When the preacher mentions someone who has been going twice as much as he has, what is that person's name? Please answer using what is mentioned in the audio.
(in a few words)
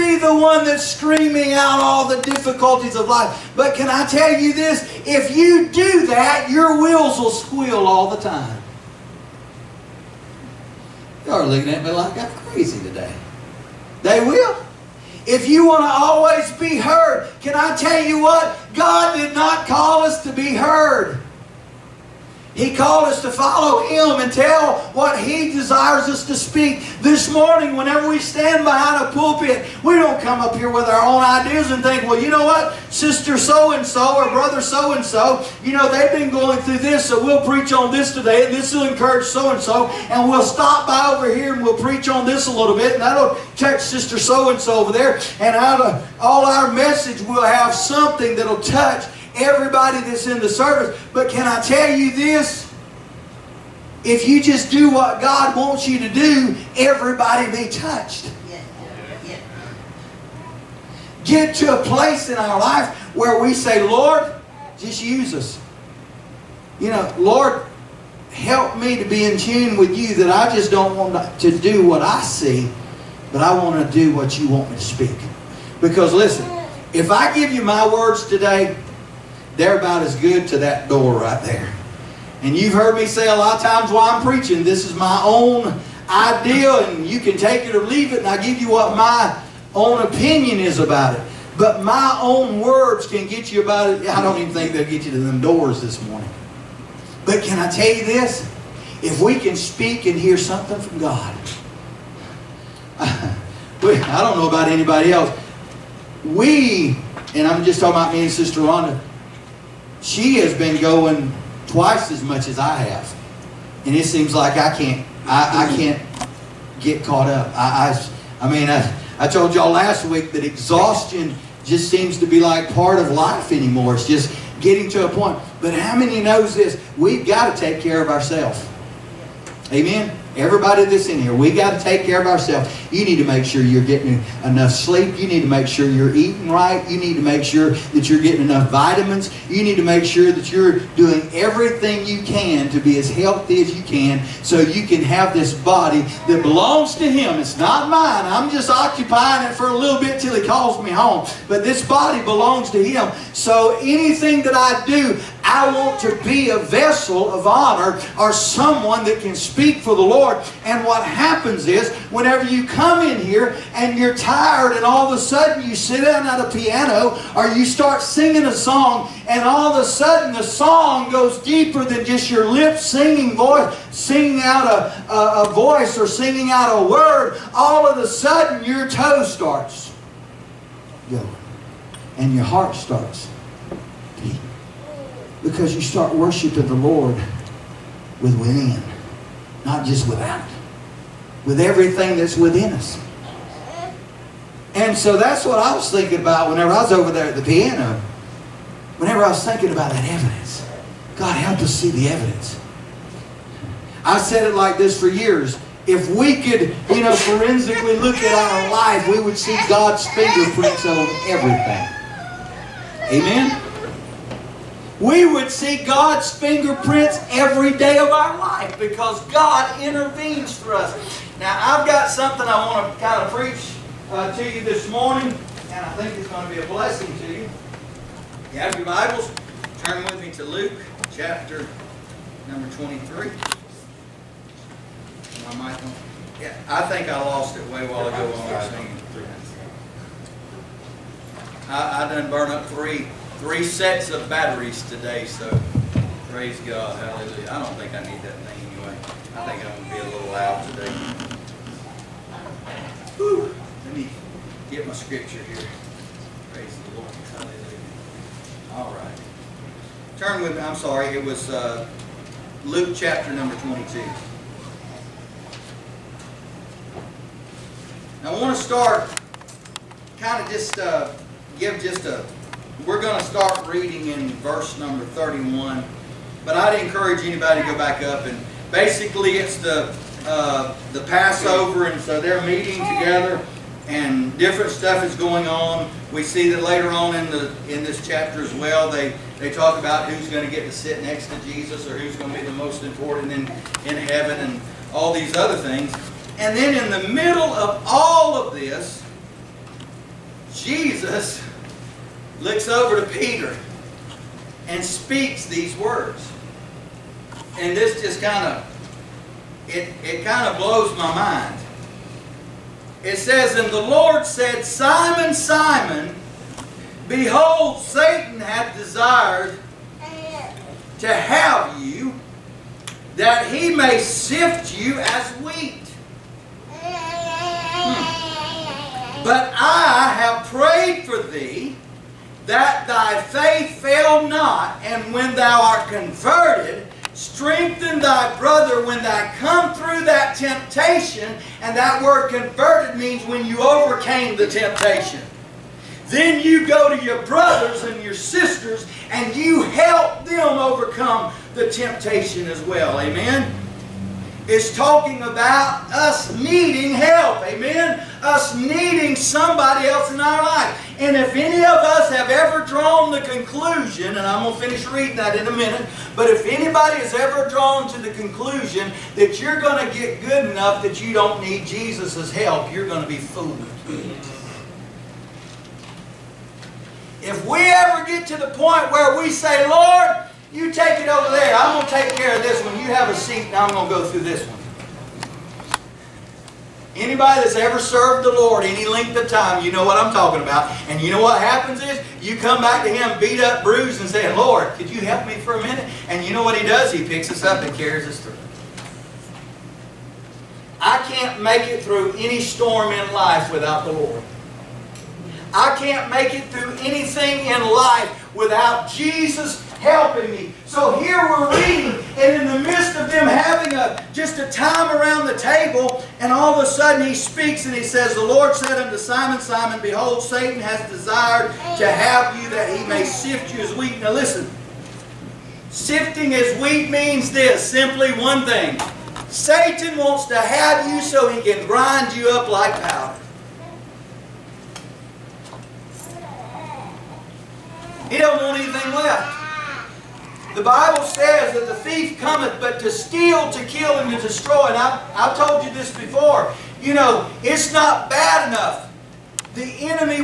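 Sister Rhonda.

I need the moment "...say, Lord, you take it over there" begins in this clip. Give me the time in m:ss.
6:19.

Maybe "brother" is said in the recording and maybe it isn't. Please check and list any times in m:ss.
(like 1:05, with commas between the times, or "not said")
0:34, 5:38, 5:47.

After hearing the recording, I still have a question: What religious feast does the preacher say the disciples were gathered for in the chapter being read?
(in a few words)
Passover.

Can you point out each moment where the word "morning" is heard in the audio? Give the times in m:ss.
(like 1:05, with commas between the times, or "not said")
0:27, 1:36, 3:44.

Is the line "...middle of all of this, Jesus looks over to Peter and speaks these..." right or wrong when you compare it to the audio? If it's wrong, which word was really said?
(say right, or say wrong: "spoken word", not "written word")
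right.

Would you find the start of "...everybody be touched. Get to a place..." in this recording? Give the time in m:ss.
0:56.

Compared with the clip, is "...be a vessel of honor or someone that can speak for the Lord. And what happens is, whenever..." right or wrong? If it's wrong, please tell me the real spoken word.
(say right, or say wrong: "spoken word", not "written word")
right.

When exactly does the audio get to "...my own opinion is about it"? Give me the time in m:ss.
1:28.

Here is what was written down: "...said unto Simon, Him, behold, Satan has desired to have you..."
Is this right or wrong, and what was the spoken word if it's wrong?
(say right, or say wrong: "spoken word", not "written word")
wrong: "Simon", not "Him".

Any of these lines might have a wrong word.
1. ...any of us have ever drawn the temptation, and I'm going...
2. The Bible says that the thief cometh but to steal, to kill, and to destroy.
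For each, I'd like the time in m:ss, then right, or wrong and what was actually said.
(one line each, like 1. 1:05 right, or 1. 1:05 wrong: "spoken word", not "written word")
1. 6:01 wrong: "conclusion", not "temptation"
2. 7:20 right.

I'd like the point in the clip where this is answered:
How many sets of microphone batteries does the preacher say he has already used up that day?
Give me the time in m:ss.
4:03.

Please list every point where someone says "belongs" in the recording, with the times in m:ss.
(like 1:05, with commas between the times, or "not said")
2:26, 2:32.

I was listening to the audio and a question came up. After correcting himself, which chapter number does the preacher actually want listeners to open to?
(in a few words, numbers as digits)
22.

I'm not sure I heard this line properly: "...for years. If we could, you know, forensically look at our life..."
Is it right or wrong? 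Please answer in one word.
right.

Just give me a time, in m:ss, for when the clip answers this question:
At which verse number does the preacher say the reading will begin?
4:35.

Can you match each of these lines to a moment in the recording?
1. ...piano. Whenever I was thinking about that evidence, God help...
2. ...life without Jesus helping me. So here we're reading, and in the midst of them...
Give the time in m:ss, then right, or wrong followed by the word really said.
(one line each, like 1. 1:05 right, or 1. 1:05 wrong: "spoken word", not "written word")
1. 3:17 right
2. 6:47 right.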